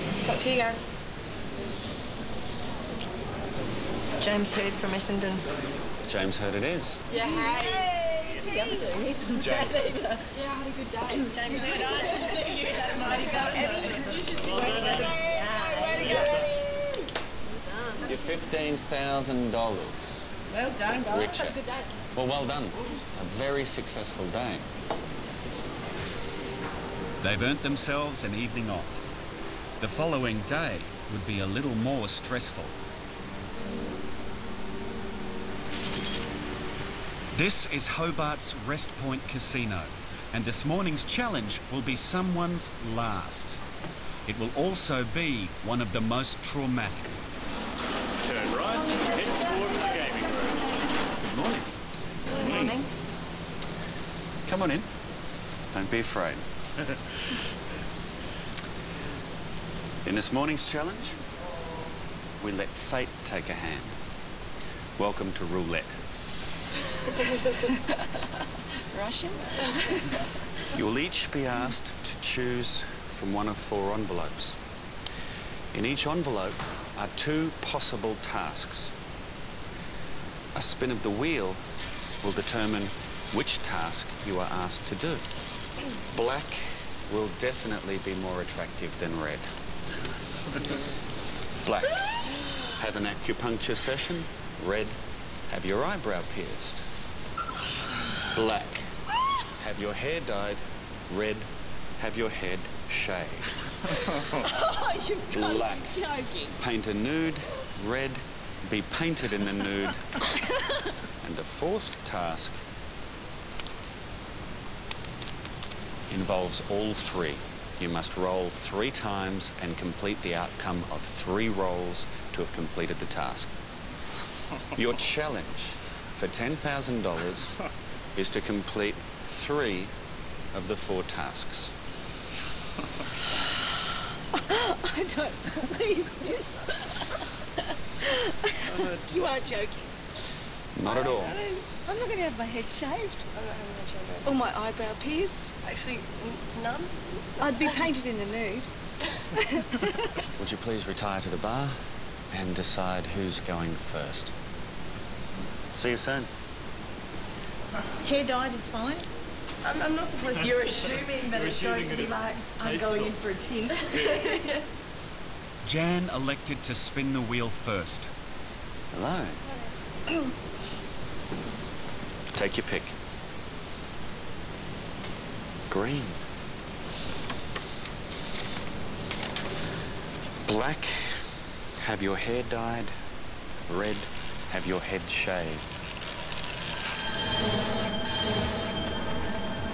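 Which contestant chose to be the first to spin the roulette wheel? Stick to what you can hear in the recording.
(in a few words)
Jan.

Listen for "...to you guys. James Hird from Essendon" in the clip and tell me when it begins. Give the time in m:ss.
0:00.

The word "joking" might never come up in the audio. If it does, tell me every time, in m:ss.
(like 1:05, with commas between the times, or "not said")
1:46, 2:19.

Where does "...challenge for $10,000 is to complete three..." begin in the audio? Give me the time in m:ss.
2:04.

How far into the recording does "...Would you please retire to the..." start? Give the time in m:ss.
2:30.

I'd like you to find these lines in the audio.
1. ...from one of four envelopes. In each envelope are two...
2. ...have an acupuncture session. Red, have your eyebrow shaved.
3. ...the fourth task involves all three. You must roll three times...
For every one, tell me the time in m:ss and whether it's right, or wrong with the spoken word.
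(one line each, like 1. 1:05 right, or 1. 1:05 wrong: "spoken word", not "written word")
1. 1:13 right
2. 1:32 wrong: "pierced", not "shaved"
3. 1:51 right.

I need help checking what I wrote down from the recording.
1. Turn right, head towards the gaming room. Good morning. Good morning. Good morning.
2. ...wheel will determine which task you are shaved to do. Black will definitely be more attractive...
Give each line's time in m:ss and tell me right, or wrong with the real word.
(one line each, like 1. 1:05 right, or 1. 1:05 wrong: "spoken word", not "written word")
1. 0:48 right
2. 1:21 wrong: "asked", not "shaved".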